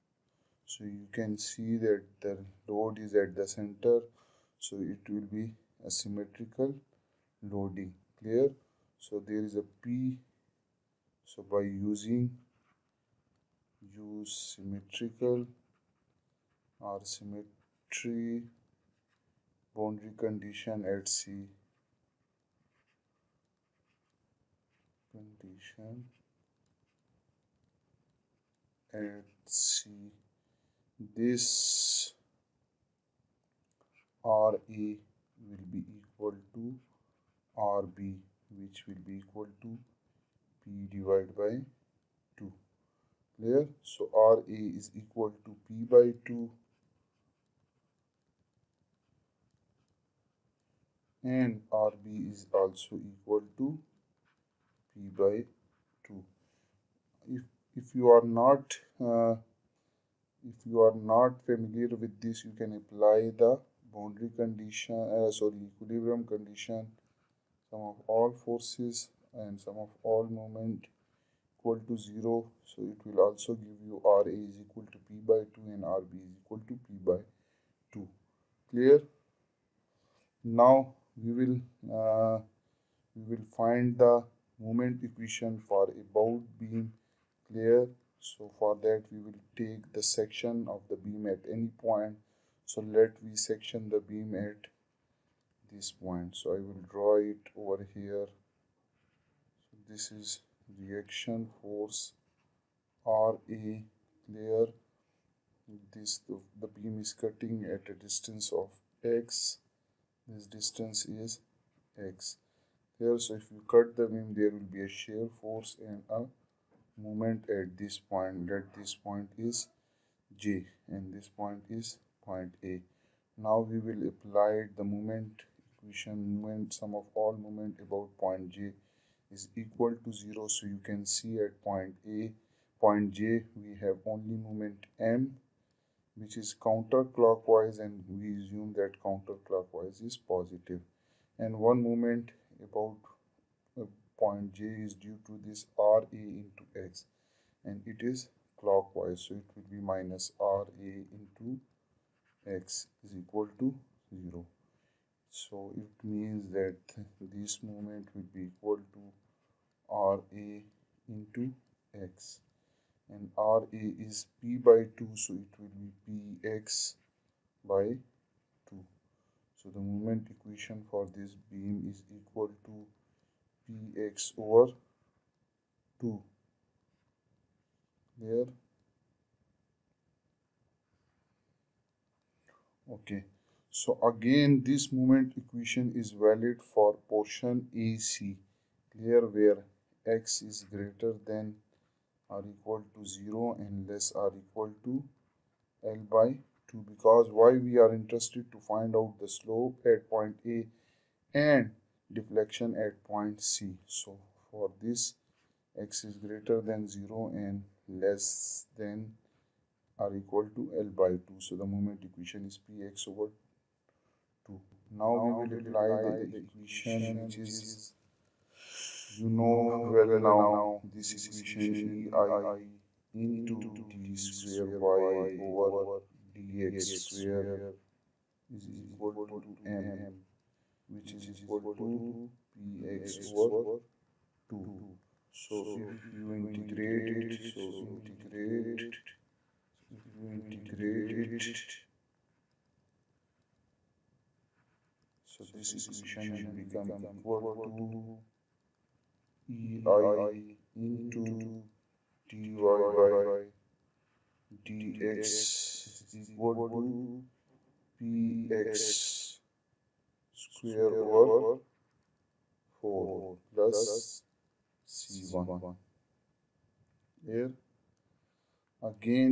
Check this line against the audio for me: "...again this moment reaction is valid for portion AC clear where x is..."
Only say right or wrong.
wrong.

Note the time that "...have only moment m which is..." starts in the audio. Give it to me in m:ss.
2:13.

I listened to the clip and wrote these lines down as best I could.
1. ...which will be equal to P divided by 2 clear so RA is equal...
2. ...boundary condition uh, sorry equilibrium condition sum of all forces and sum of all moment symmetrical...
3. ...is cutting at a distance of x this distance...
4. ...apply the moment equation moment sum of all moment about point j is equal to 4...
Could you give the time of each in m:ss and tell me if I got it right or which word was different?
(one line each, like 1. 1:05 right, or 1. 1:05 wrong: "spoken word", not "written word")
1. 0:38 right
2. 1:03 wrong: "equal", not "symmetrical"
3. 1:46 right
4. 2:04 wrong: "0", not "4".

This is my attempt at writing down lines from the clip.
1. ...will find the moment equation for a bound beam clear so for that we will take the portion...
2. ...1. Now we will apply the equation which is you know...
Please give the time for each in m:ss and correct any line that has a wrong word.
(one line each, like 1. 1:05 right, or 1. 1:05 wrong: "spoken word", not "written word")
1. 1:23 wrong: "section", not "portion"
2. 3:34 wrong: "2", not "1".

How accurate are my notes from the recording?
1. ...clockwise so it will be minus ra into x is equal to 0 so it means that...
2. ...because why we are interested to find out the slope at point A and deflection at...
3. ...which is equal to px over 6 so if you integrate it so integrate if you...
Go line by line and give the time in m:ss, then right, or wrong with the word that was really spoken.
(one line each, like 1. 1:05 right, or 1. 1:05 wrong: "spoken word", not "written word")
1. 2:28 right
2. 3:16 right
3. 3:50 wrong: "2", not "6".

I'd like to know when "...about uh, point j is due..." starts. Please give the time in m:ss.
2:22.